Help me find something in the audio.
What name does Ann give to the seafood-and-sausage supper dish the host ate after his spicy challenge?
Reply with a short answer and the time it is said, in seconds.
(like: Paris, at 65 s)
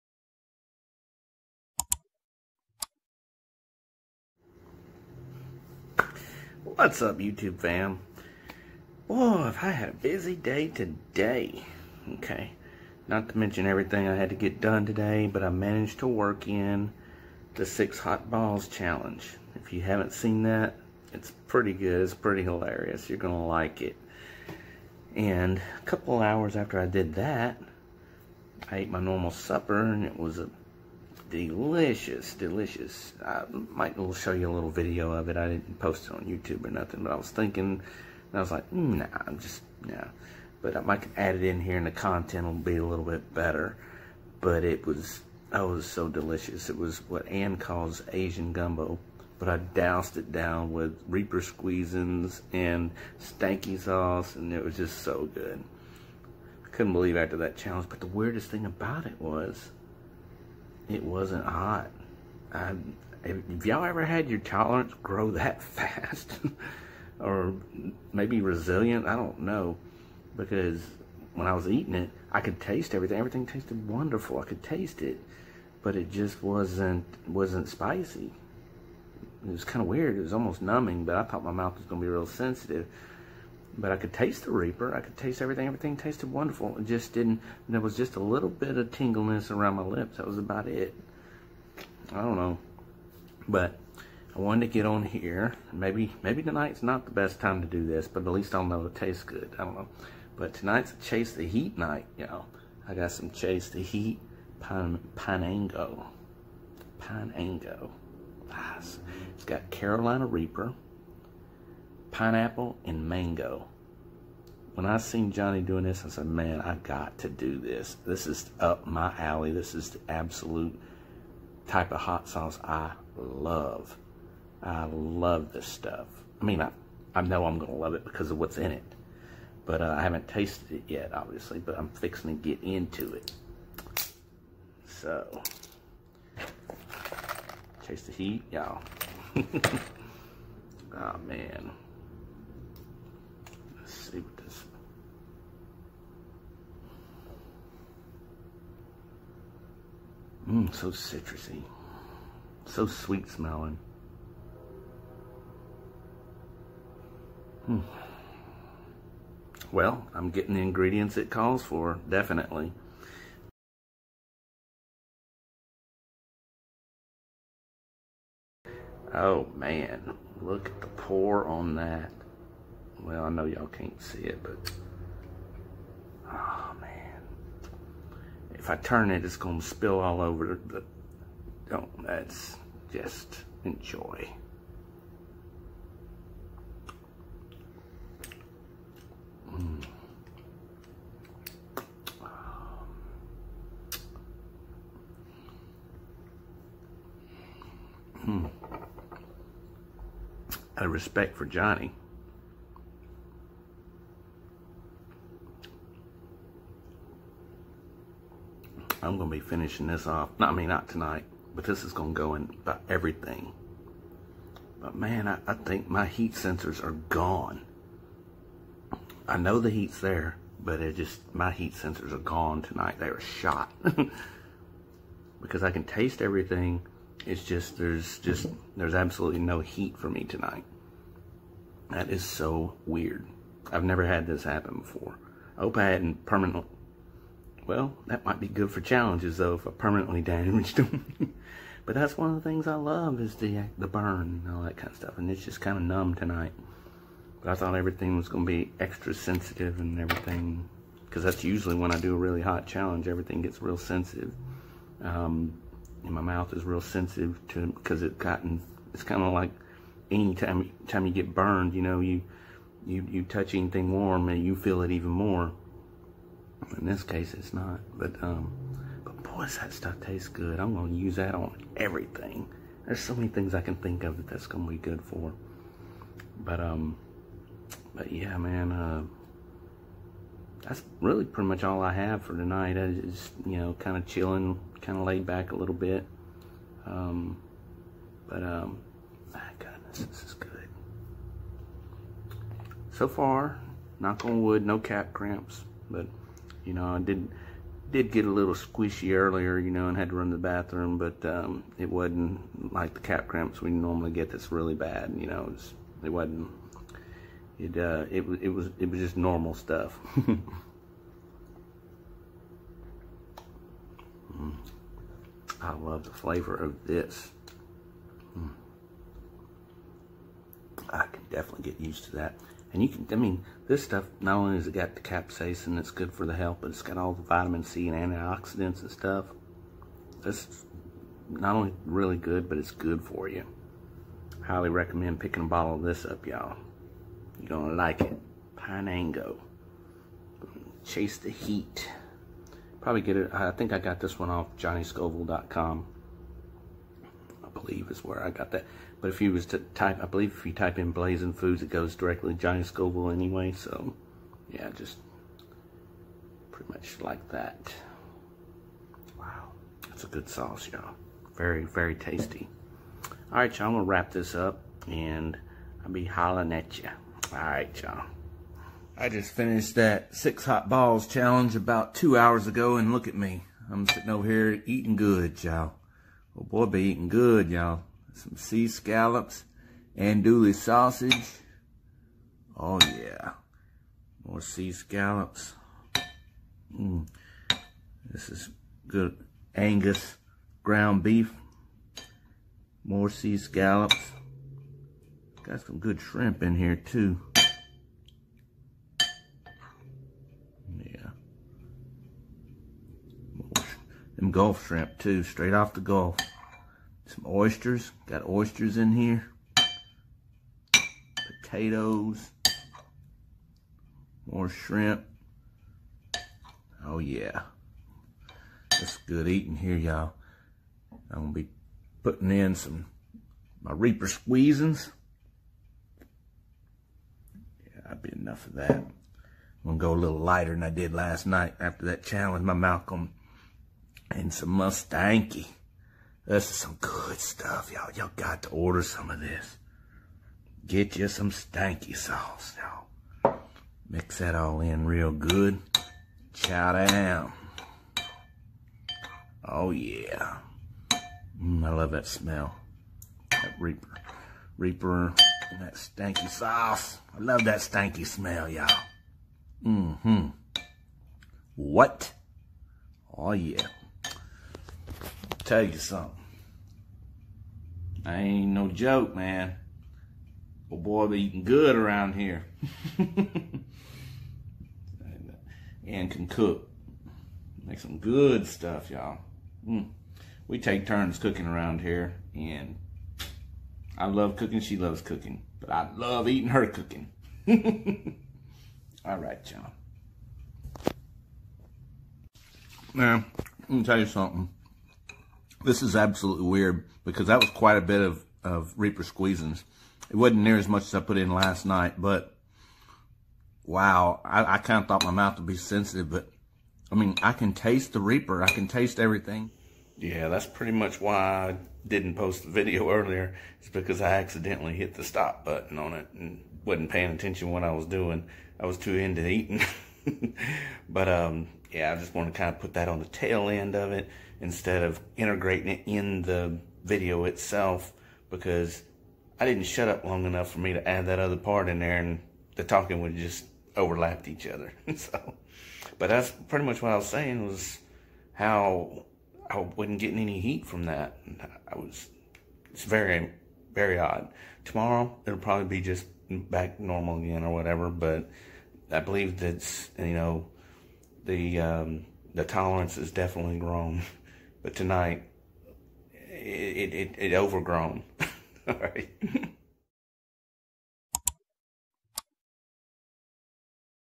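Asian gumbo, at 48 s.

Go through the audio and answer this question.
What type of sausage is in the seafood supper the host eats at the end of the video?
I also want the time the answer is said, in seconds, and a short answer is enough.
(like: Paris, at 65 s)
andouille, at 379 s.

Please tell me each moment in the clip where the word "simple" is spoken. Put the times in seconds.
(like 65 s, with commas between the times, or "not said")
not said.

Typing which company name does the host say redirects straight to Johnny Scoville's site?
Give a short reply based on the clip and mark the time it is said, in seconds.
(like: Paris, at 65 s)
Blazing Foods, at 350 s.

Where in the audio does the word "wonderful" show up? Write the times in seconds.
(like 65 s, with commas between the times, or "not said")
73 s, 86 s.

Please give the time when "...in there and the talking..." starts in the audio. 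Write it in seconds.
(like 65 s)
531 s.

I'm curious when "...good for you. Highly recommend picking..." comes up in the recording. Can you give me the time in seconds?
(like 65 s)
332 s.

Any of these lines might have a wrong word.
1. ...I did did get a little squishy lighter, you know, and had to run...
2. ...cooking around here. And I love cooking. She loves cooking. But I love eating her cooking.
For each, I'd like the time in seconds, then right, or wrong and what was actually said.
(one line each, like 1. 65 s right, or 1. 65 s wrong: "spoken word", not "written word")
1. 296 s wrong: "earlier", not "lighter"
2. 481 s right.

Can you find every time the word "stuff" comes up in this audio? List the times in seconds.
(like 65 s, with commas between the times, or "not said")
125 s, 244 s, 269 s, 309 s, 323 s, 328 s, 437 s, 478 s.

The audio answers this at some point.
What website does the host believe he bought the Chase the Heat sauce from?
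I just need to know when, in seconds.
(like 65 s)
344 s.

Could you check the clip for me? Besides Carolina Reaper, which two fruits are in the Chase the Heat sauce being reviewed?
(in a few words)
pineapple and mango.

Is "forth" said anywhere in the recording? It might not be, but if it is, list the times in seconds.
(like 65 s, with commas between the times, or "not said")
not said.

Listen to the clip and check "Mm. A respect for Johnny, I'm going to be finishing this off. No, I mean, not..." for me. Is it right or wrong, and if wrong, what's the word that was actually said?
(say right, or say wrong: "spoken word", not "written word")
right.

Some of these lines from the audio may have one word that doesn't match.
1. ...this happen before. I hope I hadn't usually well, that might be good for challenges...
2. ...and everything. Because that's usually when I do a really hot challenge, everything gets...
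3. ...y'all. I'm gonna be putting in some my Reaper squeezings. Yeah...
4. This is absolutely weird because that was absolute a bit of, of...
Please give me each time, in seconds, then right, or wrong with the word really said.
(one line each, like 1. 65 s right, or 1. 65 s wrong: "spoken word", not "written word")
1. 234 s wrong: "permanently", not "usually"
2. 249 s right
3. 419 s right
4. 495 s wrong: "quite", not "absolute".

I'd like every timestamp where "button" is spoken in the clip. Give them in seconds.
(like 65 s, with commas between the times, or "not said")
515 s.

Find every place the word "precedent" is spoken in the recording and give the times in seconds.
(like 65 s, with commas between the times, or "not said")
not said.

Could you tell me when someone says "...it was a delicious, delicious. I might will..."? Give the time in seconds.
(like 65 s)
30 s.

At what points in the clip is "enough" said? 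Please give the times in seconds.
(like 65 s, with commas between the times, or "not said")
428 s, 530 s.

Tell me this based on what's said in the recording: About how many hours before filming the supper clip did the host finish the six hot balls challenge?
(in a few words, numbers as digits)
2.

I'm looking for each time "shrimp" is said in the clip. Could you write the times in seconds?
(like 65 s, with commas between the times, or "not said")
395 s, 404 s, 414 s.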